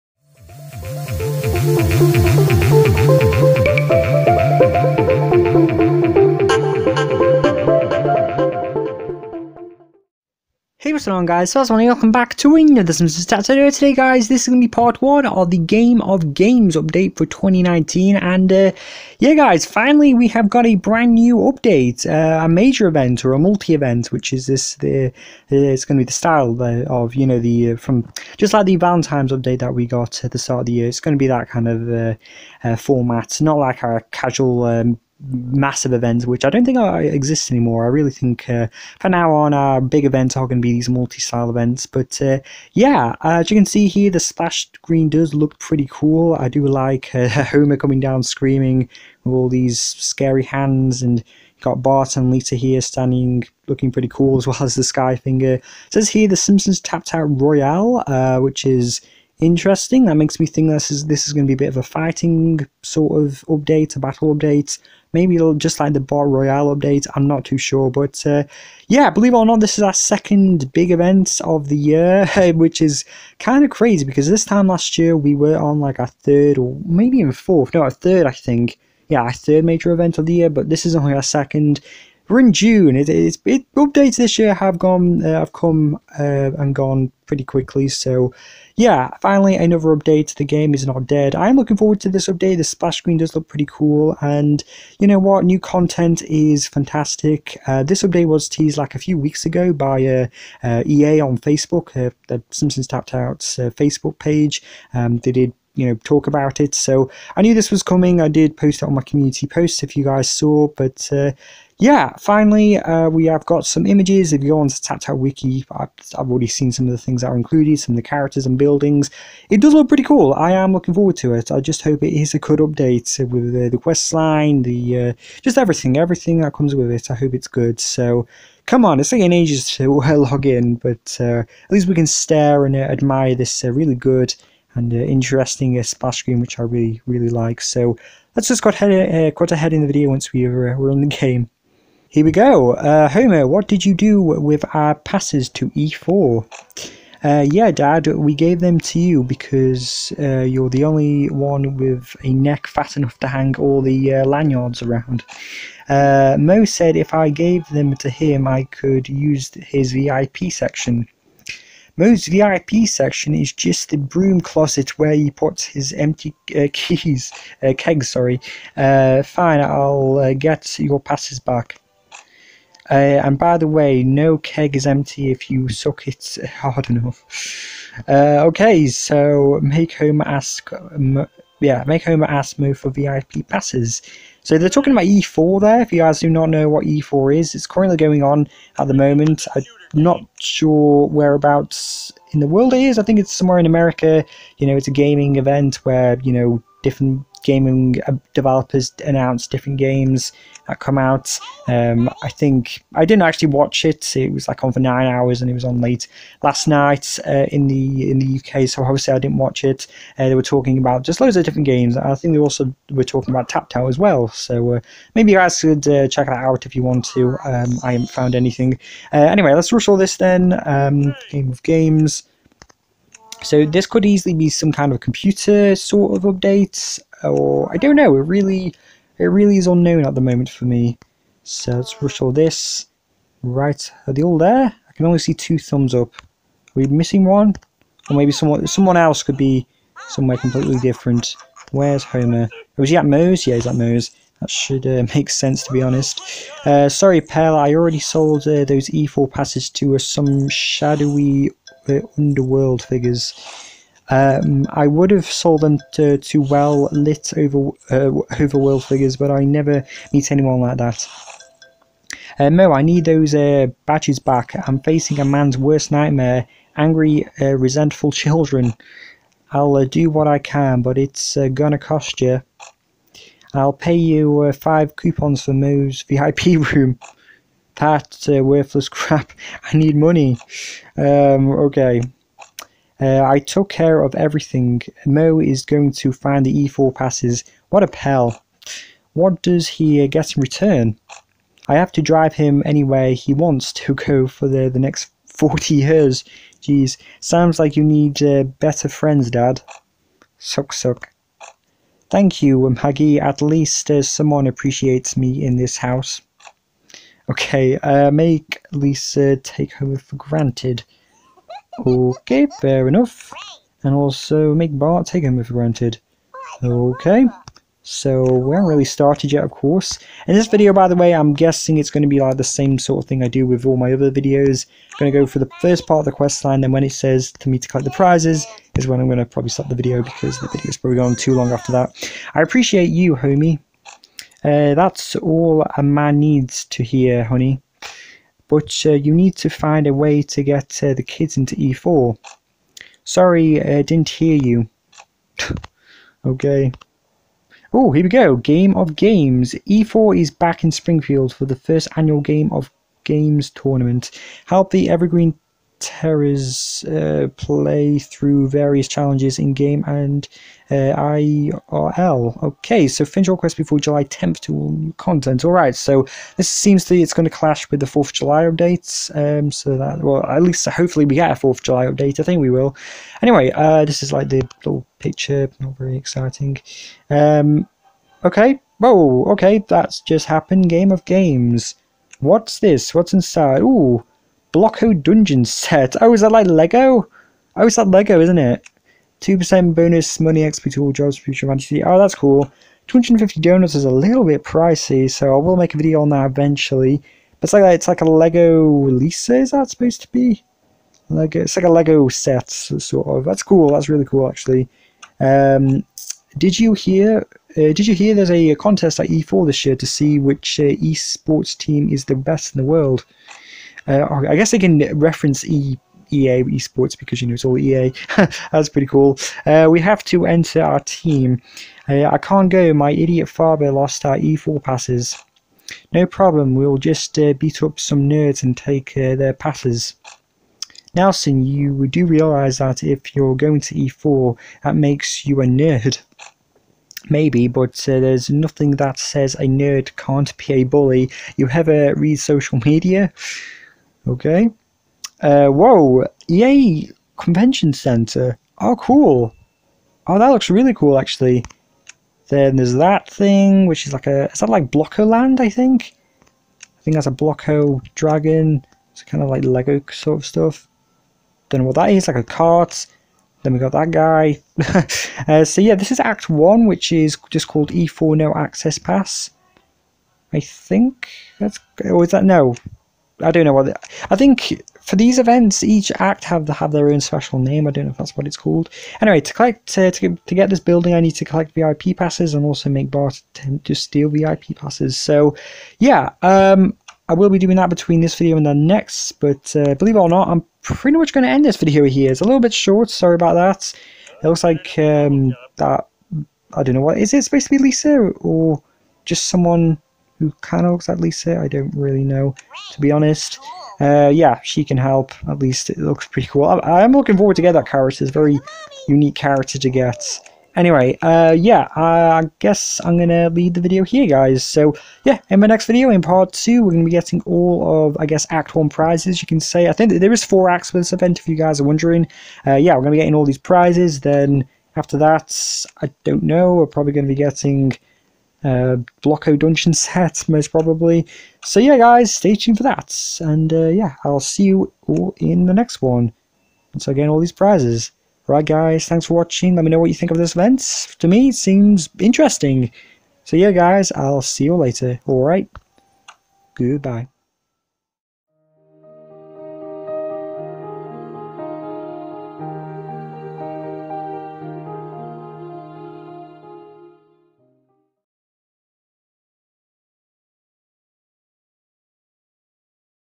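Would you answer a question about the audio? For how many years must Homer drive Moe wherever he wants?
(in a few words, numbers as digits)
40.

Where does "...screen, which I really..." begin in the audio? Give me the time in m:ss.
2:16.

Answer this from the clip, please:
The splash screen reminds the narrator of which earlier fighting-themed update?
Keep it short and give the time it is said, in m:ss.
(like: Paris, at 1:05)
Bart Royale, at 1:05.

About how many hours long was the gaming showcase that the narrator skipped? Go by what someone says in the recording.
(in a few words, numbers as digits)
9.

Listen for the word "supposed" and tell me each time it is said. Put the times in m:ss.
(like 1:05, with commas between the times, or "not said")
6:39, 8:17.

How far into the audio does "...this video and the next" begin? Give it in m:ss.
8:08.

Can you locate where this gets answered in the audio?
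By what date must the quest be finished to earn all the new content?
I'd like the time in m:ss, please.
6:03.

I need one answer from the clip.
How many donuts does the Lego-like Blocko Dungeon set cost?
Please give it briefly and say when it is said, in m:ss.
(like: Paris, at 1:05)
250, at 6:32.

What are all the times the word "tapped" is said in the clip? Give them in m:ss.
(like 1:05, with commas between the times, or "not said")
0:56, 1:42.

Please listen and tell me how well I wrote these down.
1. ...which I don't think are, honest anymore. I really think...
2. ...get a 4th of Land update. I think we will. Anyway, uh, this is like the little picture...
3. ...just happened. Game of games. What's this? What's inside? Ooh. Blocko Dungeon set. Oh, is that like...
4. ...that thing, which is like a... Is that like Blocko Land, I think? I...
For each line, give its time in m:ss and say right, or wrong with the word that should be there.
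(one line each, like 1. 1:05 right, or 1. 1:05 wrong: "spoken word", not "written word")
1. 0:36 wrong: "exist", not "honest"
2. 6:11 wrong: "July", not "Land"
3. 6:20 right
4. 7:32 right.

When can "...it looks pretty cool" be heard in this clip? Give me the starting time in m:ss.
8:25.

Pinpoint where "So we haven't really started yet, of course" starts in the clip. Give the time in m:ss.
5:17.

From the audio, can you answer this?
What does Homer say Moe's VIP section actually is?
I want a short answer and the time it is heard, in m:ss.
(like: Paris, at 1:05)
the broom closet, at 2:43.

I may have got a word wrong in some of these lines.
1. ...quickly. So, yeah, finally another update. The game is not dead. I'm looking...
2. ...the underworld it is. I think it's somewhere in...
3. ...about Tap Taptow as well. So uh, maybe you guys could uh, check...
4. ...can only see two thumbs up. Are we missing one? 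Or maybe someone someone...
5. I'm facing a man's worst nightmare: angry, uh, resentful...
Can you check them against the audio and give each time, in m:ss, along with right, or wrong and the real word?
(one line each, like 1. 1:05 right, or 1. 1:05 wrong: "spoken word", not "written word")
1. 1:27 right
2. 3:12 wrong: "world", not "underworld"
3. 3:33 right
4. 3:54 right
5. 4:24 right.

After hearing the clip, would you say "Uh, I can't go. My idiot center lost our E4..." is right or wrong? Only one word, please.
wrong.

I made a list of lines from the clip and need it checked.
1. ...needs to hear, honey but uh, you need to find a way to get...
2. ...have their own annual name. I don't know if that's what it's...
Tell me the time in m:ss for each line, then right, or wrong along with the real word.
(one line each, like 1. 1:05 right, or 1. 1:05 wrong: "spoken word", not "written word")
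1. 5:36 right
2. 7:56 wrong: "special", not "annual".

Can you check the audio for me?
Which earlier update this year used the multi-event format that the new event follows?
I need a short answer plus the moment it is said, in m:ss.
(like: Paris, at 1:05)
Valentine's, at 0:28.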